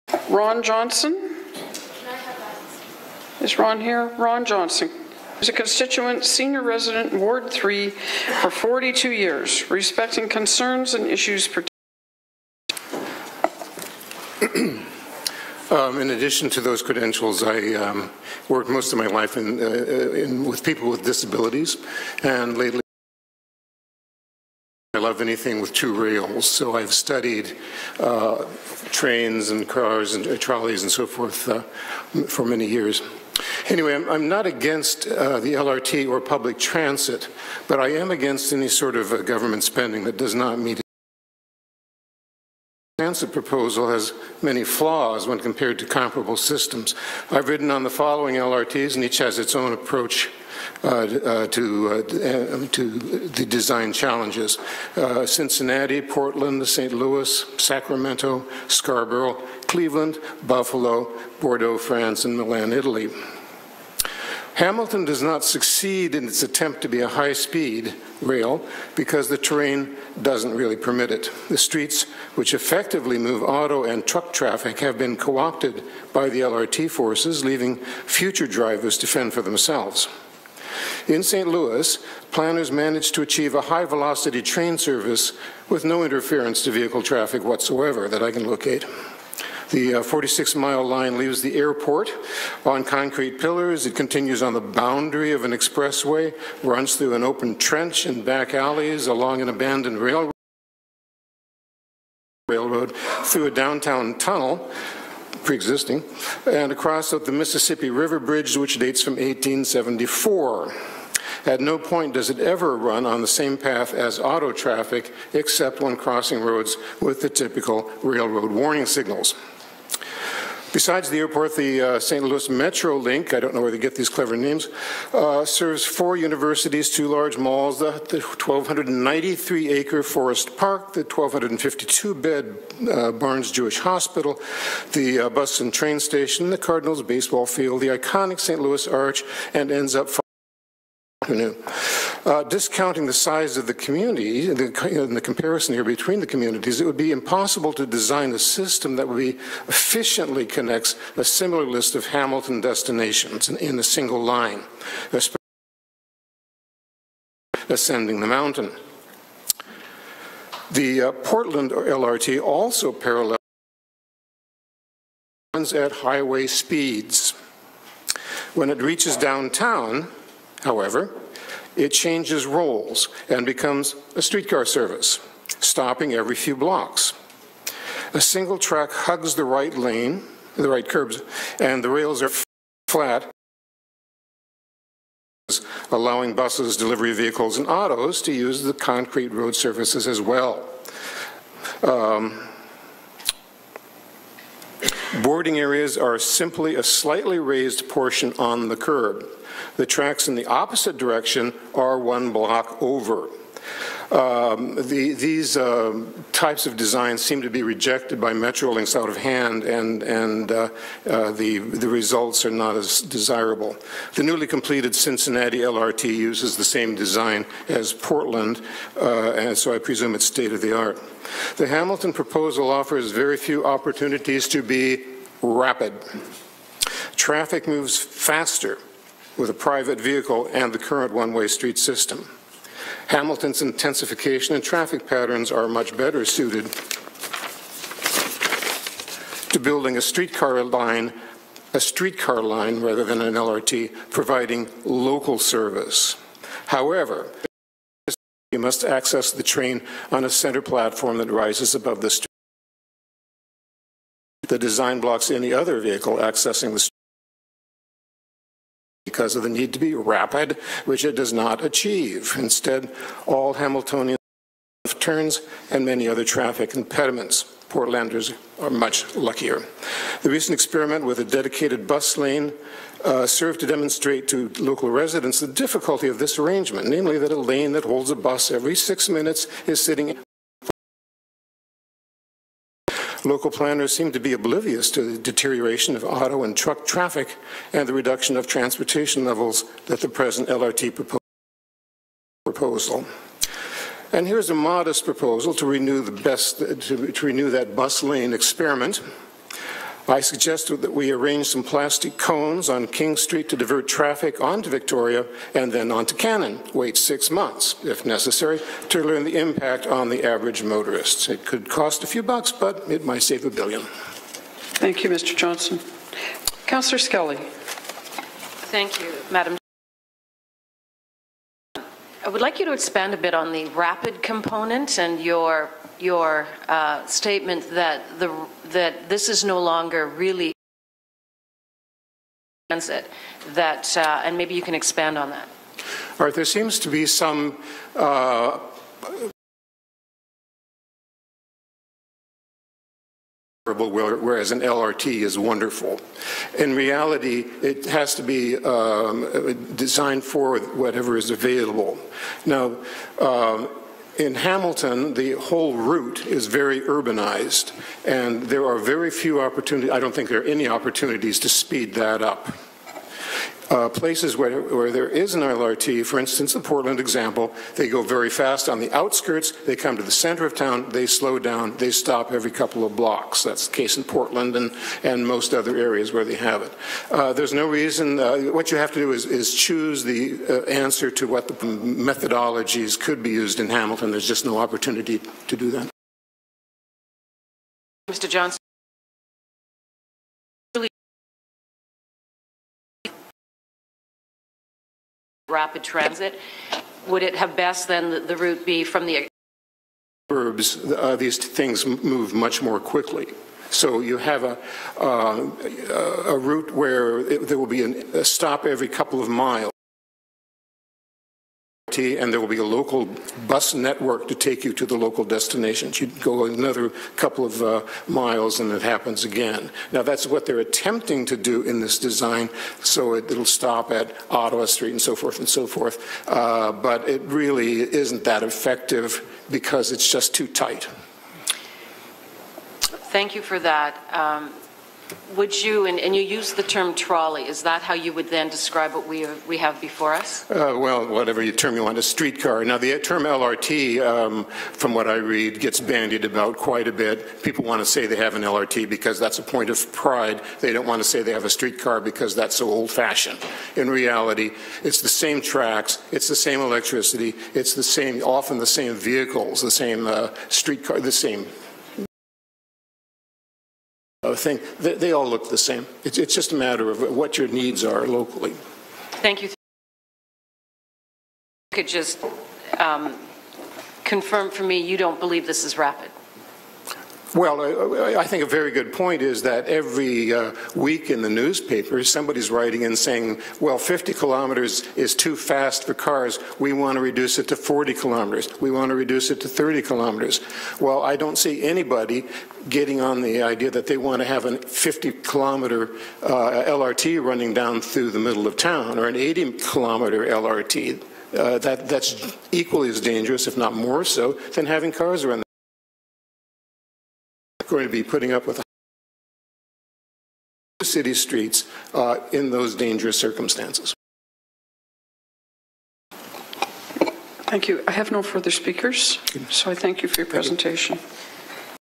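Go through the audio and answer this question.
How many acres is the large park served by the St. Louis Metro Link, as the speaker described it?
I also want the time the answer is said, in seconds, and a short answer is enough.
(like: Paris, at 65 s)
1,293, at 127 s.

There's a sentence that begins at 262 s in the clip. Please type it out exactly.
Instead, all Hamiltonian turns and many other traffic impediments.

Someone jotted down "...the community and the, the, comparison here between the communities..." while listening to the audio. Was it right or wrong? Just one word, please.
right.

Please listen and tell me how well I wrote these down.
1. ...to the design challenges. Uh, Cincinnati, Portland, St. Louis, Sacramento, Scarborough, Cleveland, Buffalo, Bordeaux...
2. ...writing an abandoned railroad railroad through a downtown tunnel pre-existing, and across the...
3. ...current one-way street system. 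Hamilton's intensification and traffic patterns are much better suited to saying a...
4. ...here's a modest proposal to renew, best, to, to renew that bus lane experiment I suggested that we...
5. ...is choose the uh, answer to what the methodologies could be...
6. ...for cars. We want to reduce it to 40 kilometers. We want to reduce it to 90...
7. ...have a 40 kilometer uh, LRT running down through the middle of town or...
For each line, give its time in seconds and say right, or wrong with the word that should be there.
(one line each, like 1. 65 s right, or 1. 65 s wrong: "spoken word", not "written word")
1. 52 s right
2. 99 s wrong: "along", not "writing"
3. 230 s wrong: "building", not "saying"
4. 294 s right
5. 379 s right
6. 485 s wrong: "30", not "90"
7. 494 s wrong: "50", not "40".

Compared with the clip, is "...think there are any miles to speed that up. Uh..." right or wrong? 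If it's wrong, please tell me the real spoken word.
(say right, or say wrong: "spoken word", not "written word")
wrong: "opportunities", not "miles".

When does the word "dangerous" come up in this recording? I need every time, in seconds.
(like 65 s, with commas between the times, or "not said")
502 s, 512 s.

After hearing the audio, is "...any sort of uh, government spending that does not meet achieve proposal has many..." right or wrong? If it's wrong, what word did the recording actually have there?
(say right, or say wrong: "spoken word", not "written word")
wrong: "comprehensive", not "achieve".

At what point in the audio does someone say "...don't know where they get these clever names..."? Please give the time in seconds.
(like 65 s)
123 s.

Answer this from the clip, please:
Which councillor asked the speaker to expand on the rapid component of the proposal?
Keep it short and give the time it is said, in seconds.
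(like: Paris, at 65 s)
Skelly, at 316 s.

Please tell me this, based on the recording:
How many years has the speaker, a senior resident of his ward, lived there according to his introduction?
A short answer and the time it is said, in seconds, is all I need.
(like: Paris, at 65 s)
42, at 8 s.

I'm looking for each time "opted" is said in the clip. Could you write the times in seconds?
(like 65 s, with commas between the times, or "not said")
75 s.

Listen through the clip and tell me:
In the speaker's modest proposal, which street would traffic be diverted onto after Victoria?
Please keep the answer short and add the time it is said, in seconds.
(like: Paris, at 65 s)
Cannon, at 306 s.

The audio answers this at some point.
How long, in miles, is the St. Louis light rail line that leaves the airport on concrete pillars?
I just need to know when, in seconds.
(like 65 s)
89 s.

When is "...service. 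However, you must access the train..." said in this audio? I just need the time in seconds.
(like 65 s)
245 s.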